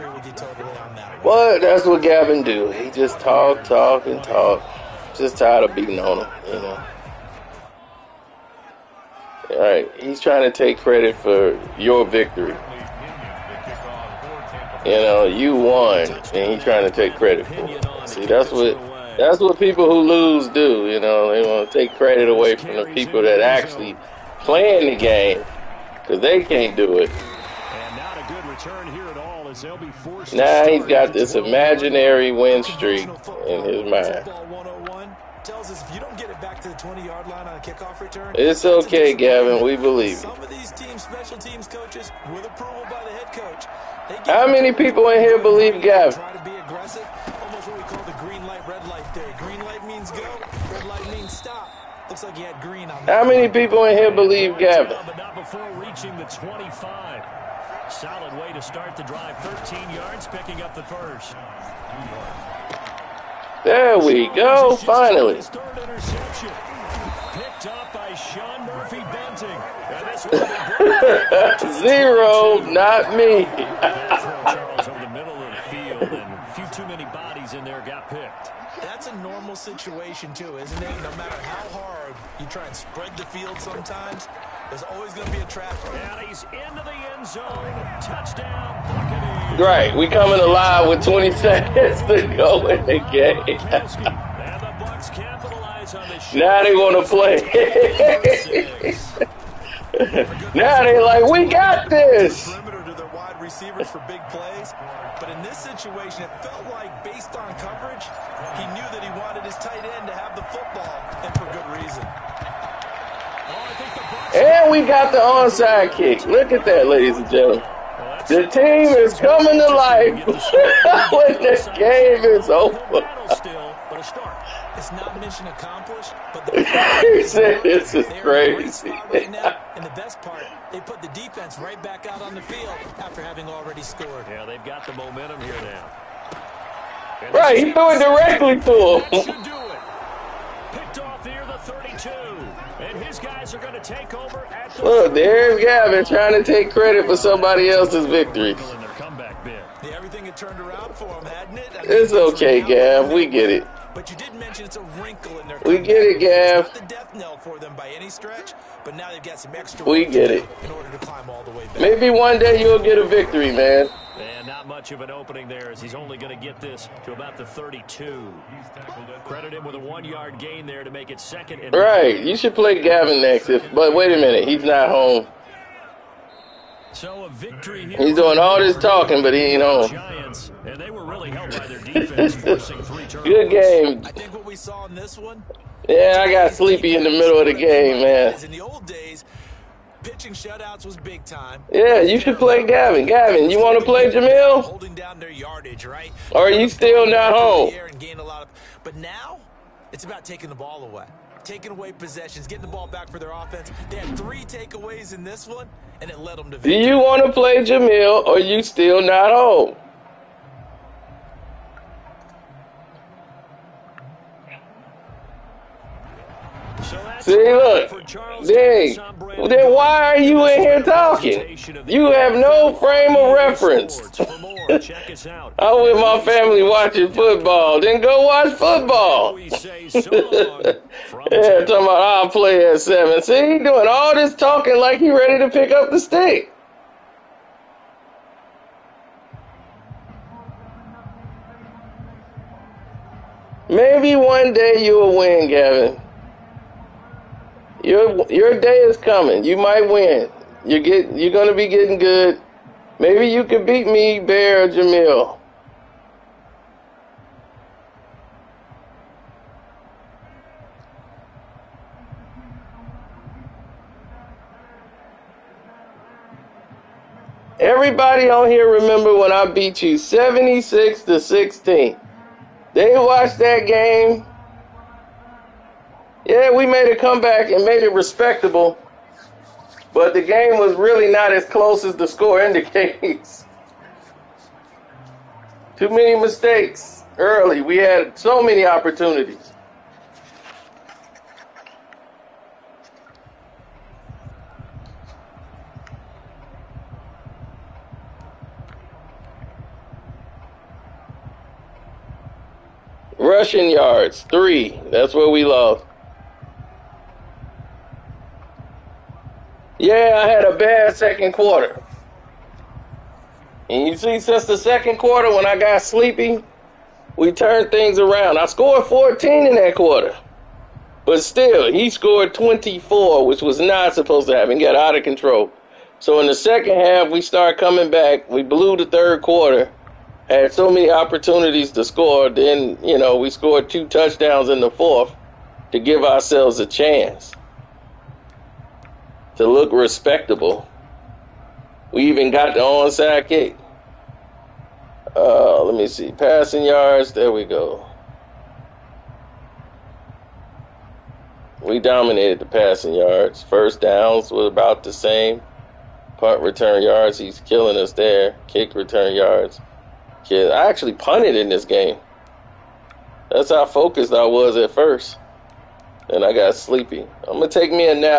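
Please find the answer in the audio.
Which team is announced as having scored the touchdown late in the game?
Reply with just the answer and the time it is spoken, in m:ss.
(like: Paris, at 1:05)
Buccaneers, at 1:28.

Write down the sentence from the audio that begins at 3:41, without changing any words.
You have no frame of reference.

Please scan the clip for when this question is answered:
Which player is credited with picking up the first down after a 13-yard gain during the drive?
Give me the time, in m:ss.
1:08.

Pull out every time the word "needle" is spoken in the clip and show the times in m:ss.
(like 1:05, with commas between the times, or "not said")
not said.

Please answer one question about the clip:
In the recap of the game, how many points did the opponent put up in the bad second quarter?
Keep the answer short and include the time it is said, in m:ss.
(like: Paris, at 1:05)
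24, at 5:22.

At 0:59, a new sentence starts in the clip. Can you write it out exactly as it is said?
13 yards, picking up the first.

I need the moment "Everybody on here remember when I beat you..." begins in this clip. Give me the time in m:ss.
4:27.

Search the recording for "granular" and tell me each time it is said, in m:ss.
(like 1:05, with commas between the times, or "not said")
not said.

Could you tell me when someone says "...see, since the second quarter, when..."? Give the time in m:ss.
5:13.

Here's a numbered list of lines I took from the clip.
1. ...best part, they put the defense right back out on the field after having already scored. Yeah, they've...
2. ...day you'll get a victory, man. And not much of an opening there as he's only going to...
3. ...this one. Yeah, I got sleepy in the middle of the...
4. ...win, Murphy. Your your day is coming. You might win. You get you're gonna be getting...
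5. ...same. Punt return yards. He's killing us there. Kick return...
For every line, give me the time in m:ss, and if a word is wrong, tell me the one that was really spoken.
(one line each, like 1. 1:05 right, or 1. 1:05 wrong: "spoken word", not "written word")
1. 2:09 right
2. 2:42 right
3. 3:04 right
4. 4:05 wrong: "Gavin", not "Murphy"
5. 5:54 right.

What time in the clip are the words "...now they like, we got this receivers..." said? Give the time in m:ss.
1:40.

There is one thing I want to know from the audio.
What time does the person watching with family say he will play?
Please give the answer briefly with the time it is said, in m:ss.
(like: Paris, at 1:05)
7, at 3:52.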